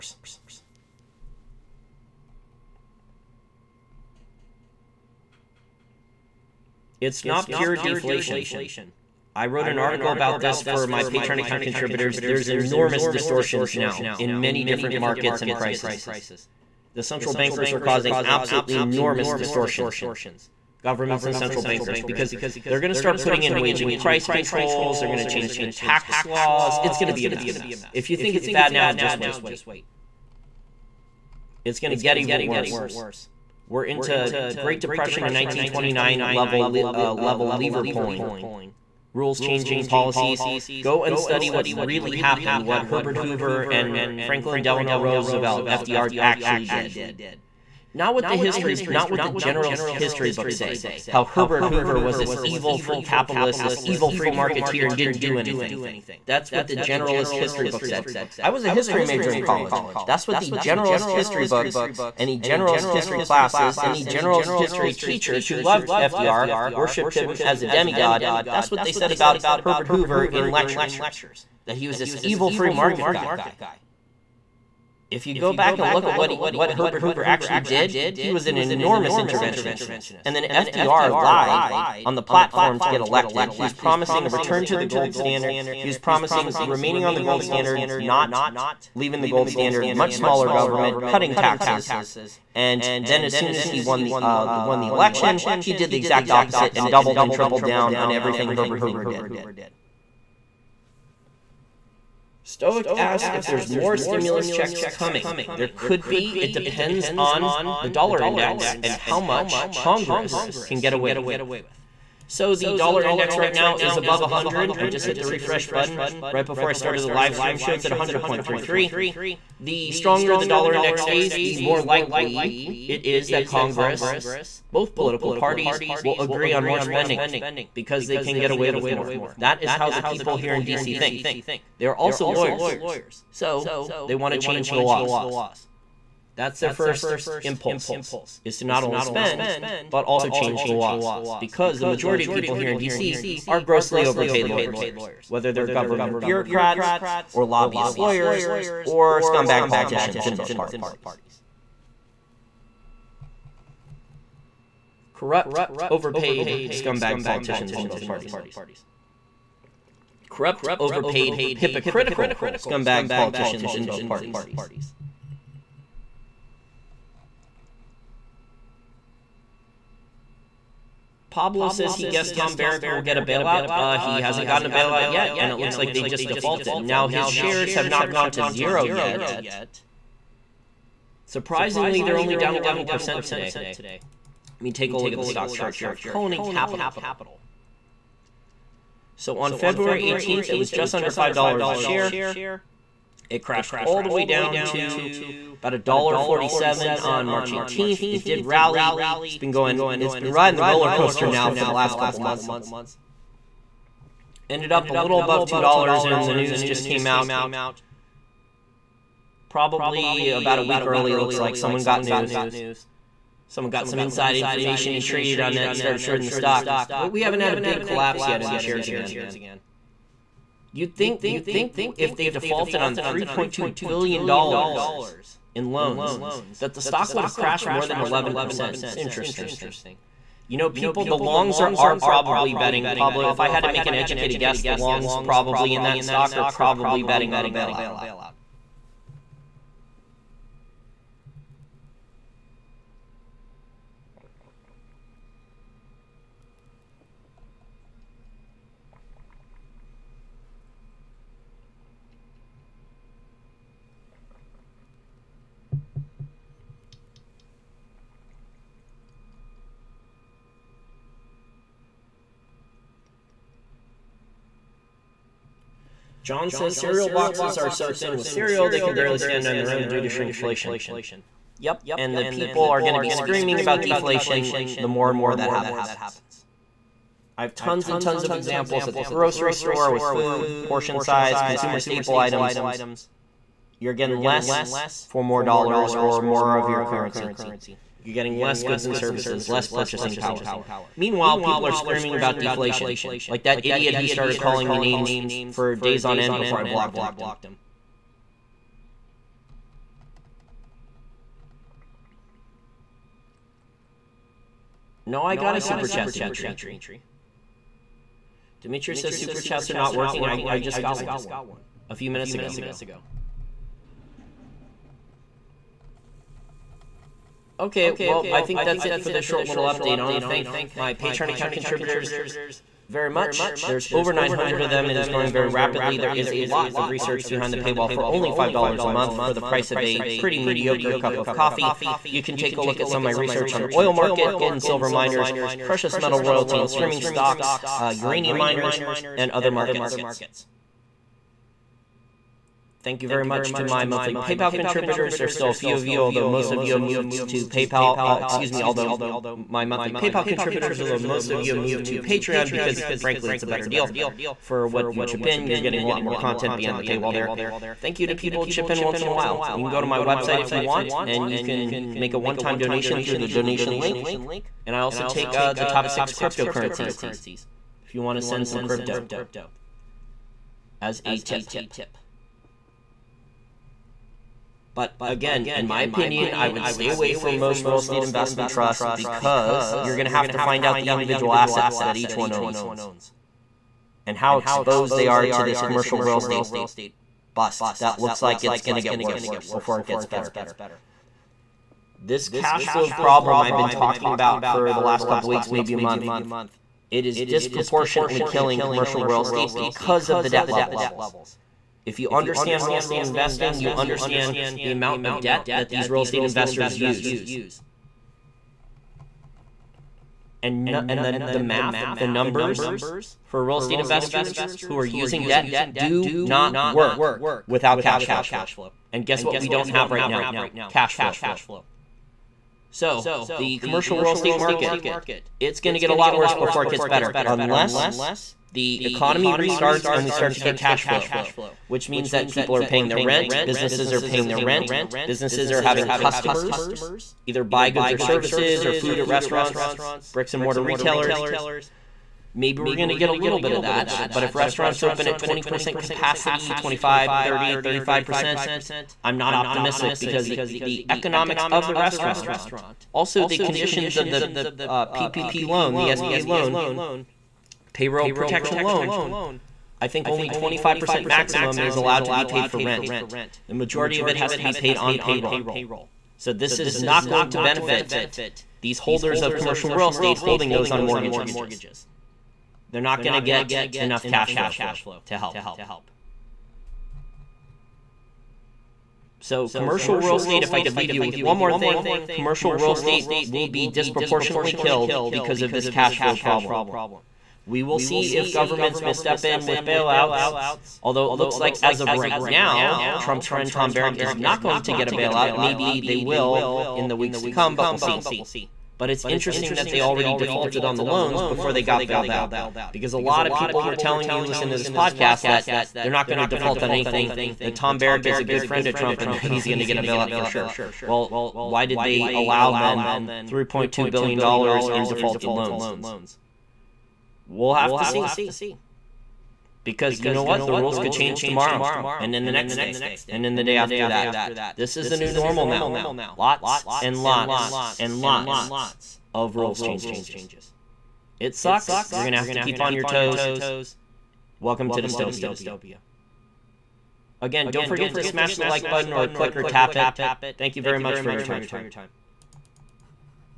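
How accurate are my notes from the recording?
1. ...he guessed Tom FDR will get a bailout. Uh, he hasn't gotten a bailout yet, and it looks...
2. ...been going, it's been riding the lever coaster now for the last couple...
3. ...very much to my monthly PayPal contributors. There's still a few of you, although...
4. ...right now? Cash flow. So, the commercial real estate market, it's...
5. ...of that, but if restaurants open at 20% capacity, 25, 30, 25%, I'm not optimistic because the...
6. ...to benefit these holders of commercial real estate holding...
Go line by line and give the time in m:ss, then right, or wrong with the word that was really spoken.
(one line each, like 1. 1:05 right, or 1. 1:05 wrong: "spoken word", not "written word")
1. 2:51 wrong: "Barrack", not "FDR"
2. 3:19 wrong: "roller", not "lever"
3. 5:43 right
4. 6:59 right
5. 7:23 wrong: "35", not "25"
6. 7:47 right.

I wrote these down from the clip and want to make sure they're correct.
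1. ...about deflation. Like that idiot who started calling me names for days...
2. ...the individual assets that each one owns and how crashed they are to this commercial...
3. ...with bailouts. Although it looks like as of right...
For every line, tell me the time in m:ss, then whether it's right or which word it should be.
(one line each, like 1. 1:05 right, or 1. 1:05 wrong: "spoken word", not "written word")
1. 4:52 right
2. 6:20 wrong: "exposed", not "crashed"
3. 8:09 right.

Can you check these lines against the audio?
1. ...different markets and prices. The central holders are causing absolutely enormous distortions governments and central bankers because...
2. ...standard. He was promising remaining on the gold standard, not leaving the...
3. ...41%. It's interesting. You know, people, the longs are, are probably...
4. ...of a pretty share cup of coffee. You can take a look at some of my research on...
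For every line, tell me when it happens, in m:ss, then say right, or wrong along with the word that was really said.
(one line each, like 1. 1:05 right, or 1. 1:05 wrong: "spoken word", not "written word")
1. 0:14 wrong: "bankers", not "holders"
2. 1:25 right
3. 3:47 wrong: "11", not "41"
4. 5:29 wrong: "mediocre", not "share".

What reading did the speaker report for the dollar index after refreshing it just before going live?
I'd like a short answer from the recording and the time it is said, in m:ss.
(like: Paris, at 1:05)
100.33, at 1:57.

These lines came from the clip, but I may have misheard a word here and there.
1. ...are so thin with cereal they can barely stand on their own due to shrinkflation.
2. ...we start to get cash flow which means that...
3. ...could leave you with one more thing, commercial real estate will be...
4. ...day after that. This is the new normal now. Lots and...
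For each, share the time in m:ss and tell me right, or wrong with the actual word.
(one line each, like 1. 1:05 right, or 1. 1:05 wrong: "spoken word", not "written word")
1. 4:27 right
2. 7:10 right
3. 8:00 right
4. 8:43 right.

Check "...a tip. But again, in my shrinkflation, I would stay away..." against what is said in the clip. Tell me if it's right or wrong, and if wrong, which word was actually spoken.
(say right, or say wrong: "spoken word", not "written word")
wrong: "opinion", not "shrinkflation".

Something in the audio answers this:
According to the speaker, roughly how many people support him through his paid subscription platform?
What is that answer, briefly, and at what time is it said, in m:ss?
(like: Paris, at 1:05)
over 900, at 5:23.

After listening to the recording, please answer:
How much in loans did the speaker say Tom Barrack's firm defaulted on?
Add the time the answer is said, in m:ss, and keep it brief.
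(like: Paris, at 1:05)
$3.2 billion, at 3:42.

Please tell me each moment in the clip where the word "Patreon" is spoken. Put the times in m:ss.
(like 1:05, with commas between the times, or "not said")
0:11, 5:20, 5:51.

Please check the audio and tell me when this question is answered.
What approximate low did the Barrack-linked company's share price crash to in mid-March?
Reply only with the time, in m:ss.
3:15.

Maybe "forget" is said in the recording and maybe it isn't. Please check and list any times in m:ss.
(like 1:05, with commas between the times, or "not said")
8:57.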